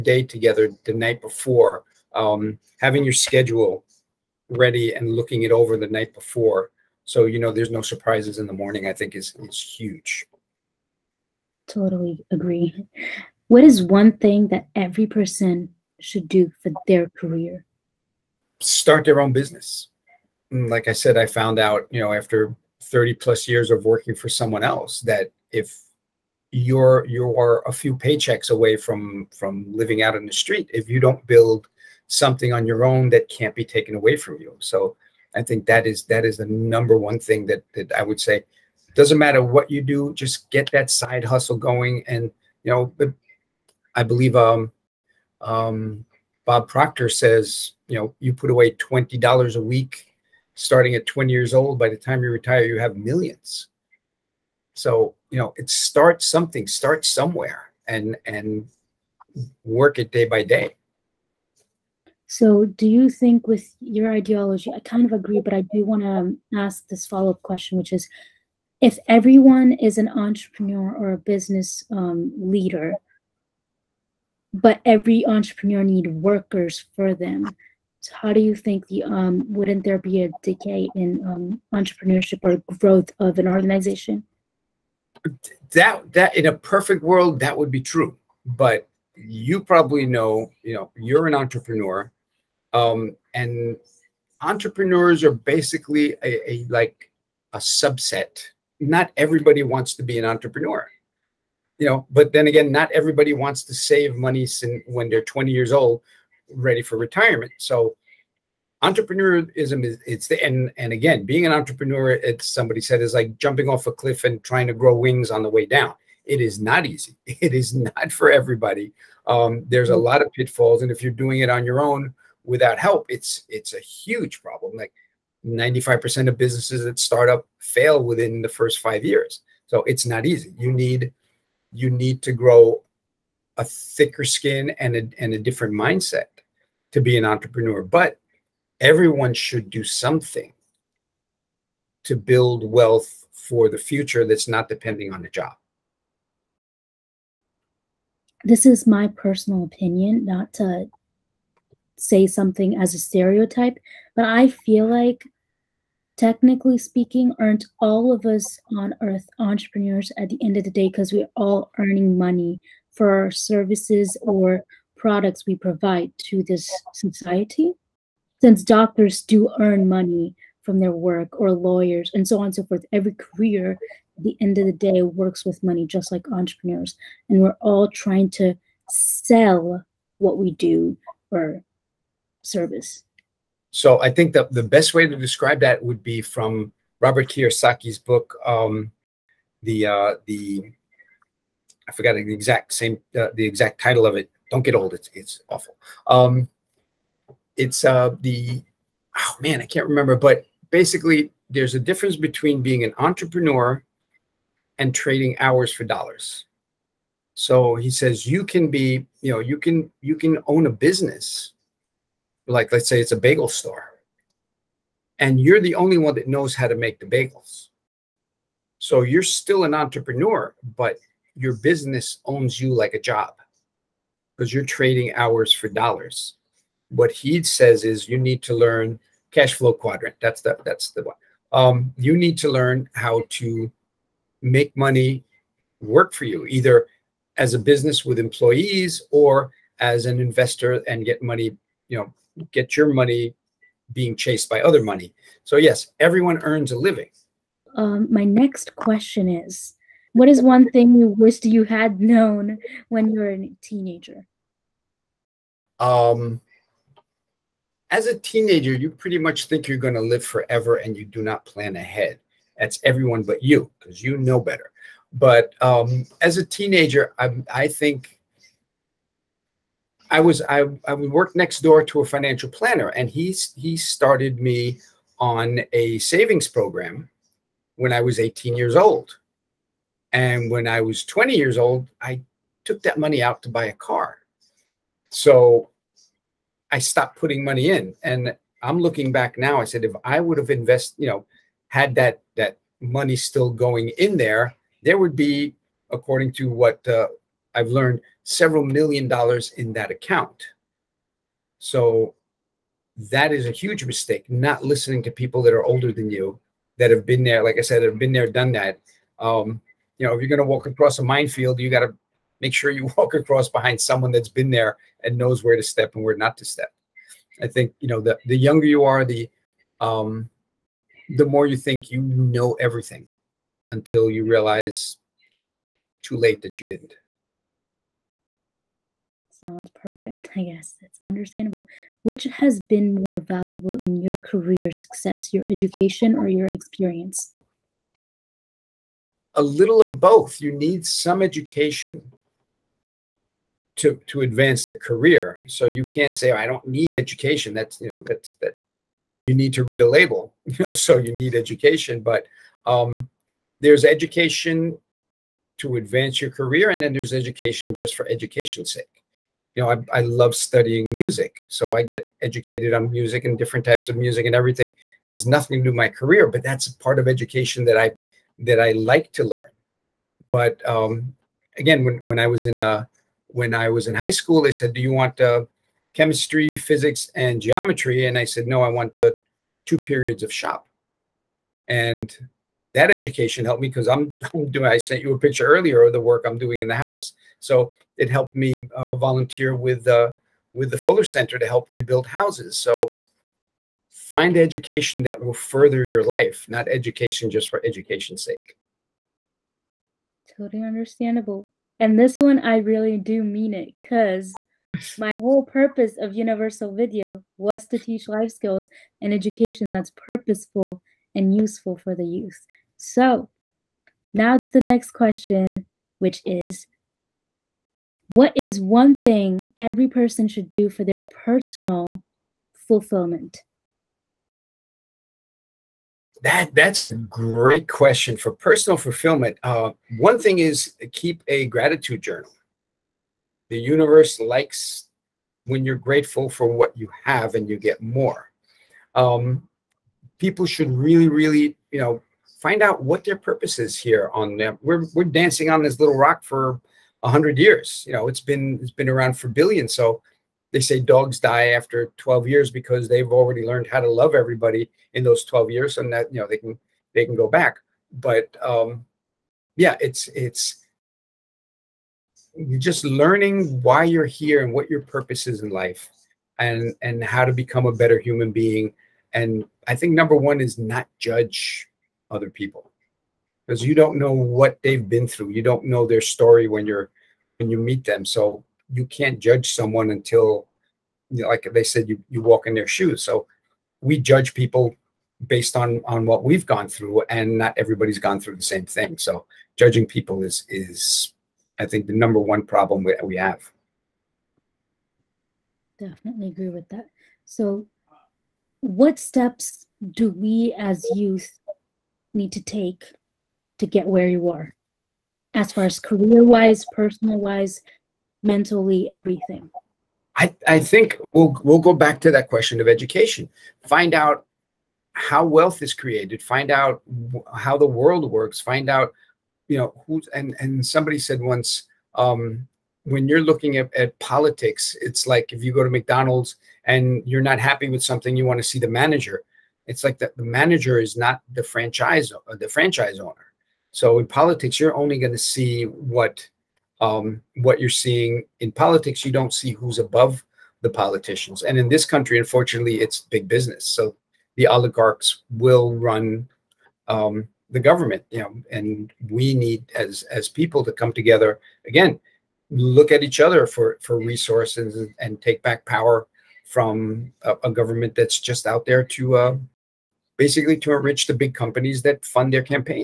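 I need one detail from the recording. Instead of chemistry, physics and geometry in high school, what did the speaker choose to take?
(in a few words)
Two periods of shop.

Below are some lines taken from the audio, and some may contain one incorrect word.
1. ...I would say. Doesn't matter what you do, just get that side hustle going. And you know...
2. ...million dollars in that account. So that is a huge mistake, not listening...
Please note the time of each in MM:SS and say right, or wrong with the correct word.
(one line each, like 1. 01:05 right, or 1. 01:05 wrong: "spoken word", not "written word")
1. 00:37 right
2. 04:58 right.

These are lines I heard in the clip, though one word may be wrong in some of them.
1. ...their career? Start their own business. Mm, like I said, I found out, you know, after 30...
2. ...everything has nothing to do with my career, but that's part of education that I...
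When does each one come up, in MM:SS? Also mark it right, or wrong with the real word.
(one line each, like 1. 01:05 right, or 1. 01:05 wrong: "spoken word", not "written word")
1. 00:16 right
2. 06:04 right.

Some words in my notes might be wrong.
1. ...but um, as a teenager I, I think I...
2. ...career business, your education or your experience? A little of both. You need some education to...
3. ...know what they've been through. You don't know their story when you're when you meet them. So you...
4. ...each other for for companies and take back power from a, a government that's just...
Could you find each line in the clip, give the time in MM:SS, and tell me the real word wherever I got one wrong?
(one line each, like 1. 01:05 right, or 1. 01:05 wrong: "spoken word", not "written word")
1. 04:25 right
2. 05:34 wrong: "success", not "business"
3. 07:53 right
4. 09:13 wrong: "resources", not "companies".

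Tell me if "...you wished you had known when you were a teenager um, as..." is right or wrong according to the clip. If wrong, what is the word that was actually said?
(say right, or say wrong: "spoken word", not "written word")
right.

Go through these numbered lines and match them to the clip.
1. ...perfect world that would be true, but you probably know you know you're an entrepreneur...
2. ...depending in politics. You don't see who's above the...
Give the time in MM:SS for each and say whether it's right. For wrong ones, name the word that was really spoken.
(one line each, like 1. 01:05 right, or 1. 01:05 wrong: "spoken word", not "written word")
1. 01:26 right
2. 08:57 wrong: "seeing", not "depending".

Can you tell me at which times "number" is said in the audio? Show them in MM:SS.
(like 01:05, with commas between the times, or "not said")
00:36, 07:49, 08:11.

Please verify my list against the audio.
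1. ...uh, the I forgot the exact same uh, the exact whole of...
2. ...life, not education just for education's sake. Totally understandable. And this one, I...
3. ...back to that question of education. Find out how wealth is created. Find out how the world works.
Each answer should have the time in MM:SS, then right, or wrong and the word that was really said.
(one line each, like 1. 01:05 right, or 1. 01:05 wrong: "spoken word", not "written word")
1. 03:09 wrong: "title", not "whole"
2. 06:36 right
3. 08:31 right.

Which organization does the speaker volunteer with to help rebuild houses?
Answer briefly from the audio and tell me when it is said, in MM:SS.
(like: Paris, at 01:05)
Fuller Center, at 06:30.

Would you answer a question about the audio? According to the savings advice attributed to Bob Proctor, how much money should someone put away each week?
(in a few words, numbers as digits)
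$20.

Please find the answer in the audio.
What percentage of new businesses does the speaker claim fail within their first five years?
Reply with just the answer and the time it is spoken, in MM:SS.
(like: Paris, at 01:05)
95%, at 02:05.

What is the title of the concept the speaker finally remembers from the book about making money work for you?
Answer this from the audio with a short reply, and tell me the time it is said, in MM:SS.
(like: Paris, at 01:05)
Cash flow quadrant, at 03:49.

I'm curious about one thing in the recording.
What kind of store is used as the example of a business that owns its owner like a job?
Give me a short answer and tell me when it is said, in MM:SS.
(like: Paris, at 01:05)
bagel store, at 03:33.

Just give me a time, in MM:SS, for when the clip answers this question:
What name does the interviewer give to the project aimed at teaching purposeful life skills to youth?
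06:46.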